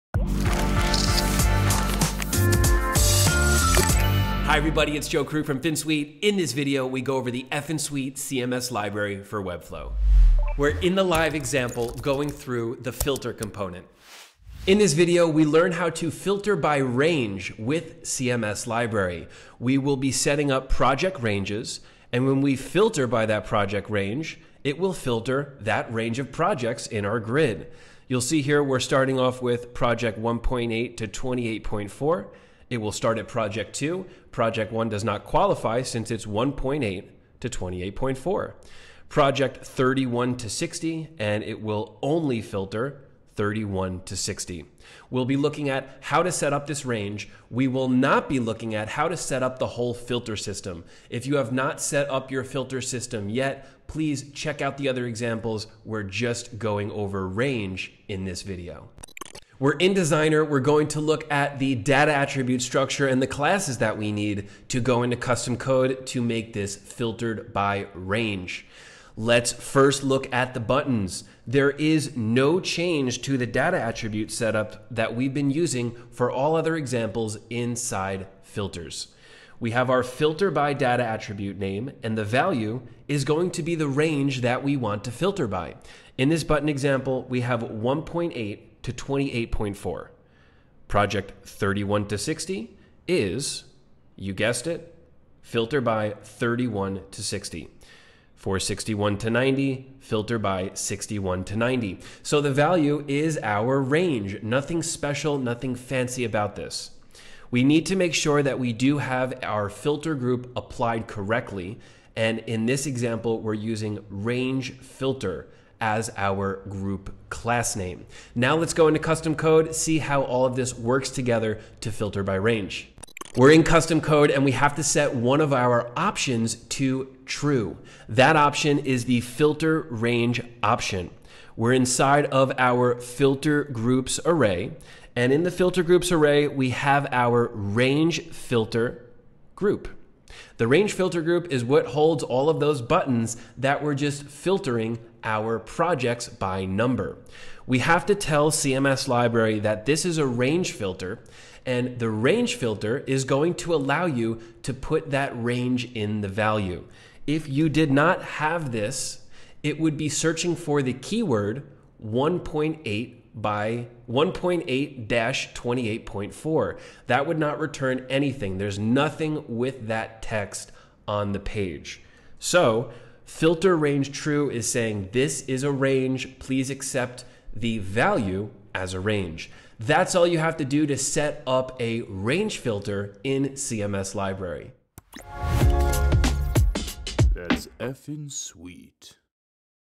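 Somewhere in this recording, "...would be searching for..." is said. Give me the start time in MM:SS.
02:39.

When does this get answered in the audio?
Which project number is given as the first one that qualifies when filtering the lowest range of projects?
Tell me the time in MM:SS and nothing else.
00:33.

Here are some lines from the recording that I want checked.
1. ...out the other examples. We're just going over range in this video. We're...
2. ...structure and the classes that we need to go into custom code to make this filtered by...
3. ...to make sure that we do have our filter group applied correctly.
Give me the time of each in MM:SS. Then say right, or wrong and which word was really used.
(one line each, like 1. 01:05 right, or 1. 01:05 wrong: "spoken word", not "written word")
1. 00:54 right
2. 01:02 right
3. 01:47 right.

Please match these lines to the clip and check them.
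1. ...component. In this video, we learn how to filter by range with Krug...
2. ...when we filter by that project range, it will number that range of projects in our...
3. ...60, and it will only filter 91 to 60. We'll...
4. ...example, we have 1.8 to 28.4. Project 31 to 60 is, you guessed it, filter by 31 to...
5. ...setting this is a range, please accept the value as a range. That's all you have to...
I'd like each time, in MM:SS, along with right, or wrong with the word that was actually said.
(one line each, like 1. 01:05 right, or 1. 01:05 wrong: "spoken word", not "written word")
1. 00:13 wrong: "CMS", not "Krug"
2. 00:22 wrong: "filter", not "number"
3. 00:40 wrong: "31", not "91"
4. 01:26 right
5. 02:54 wrong: "saying", not "setting".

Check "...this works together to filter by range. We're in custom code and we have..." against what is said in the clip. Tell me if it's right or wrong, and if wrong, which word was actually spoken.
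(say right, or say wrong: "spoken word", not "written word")
right.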